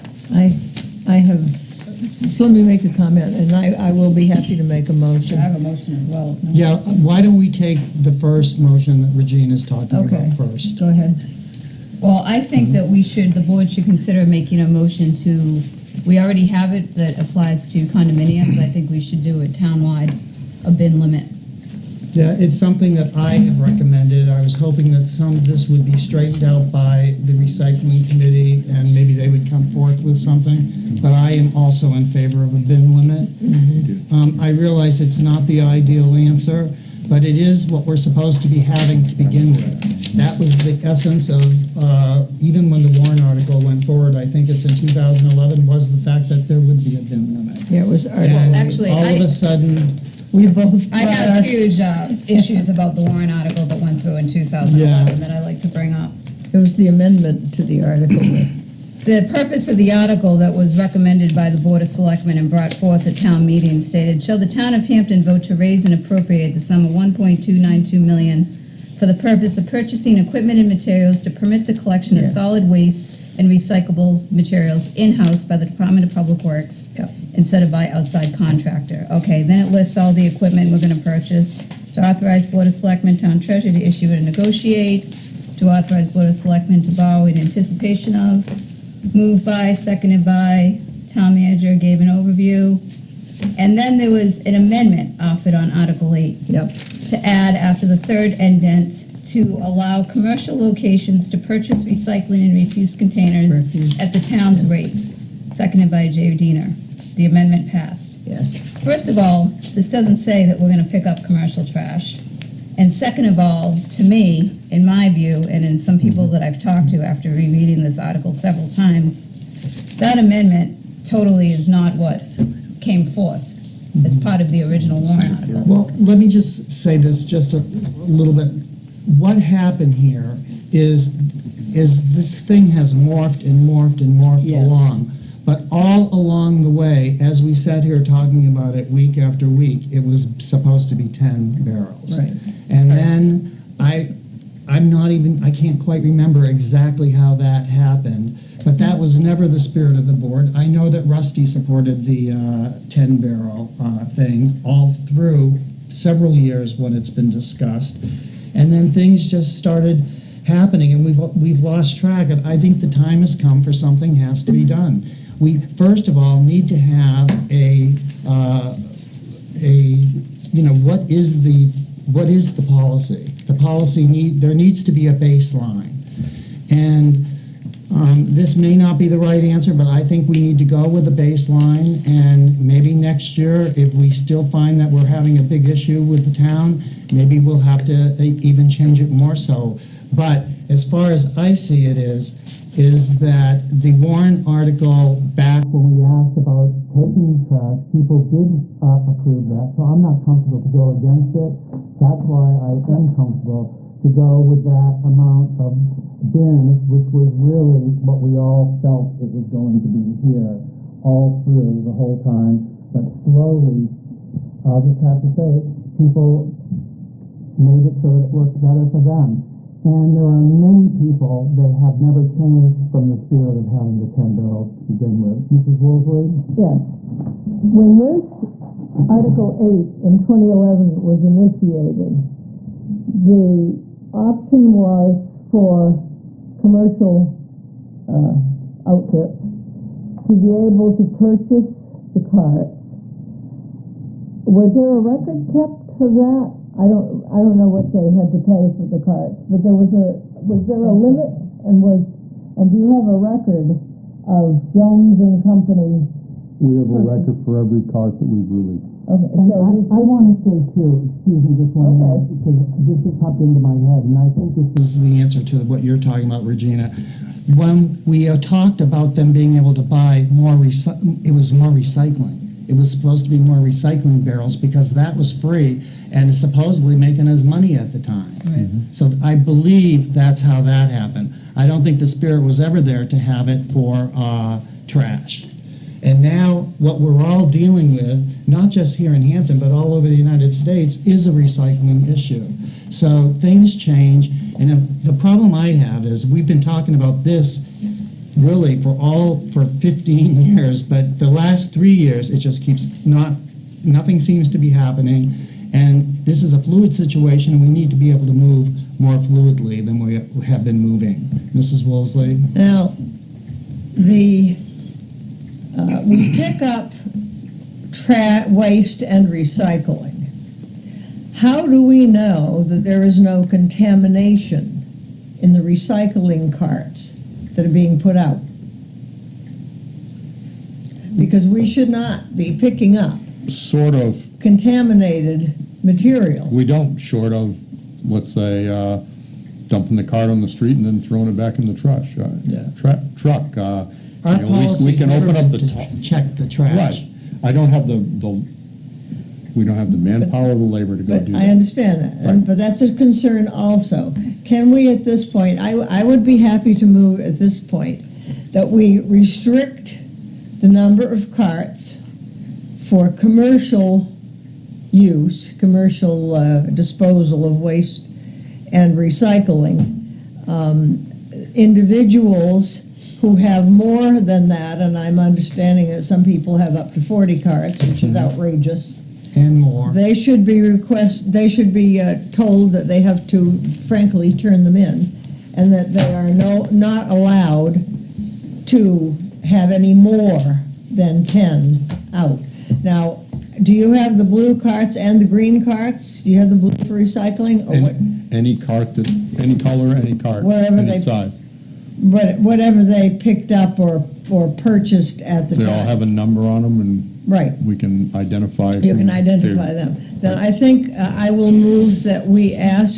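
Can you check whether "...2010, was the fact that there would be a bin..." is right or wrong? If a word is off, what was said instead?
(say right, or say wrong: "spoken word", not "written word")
wrong: "2011", not "2010".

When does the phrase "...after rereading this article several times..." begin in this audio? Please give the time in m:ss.
1:57.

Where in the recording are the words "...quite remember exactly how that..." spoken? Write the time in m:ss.
2:25.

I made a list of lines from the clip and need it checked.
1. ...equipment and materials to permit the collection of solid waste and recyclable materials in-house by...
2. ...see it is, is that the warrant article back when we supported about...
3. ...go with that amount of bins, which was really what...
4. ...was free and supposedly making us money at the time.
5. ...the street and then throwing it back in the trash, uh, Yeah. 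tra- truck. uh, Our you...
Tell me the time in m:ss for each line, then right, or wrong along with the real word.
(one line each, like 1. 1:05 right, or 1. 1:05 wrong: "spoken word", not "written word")
1. 1:10 right
2. 3:11 wrong: "asked", not "supported"
3. 3:24 right
4. 4:35 right
5. 5:40 right.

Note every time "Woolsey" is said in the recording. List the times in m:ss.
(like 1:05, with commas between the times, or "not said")
3:45, 5:11.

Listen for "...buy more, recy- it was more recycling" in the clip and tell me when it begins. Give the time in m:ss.
4:29.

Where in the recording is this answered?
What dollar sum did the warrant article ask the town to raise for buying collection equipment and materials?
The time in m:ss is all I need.
1:06.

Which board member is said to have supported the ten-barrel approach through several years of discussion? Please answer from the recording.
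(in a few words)
Rusty.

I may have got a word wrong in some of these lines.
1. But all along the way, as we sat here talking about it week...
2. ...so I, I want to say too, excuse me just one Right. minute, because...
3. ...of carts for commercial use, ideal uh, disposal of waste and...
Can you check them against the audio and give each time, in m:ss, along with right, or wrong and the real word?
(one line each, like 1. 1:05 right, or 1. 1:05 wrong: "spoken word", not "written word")
1. 2:15 right
2. 4:19 wrong: "Okay", not "Right"
3. 6:01 wrong: "commercial", not "ideal".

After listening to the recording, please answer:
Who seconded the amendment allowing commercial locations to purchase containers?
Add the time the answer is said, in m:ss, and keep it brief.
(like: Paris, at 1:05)
Jay Diener, at 1:46.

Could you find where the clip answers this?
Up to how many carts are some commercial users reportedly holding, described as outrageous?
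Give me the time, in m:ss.
6:17.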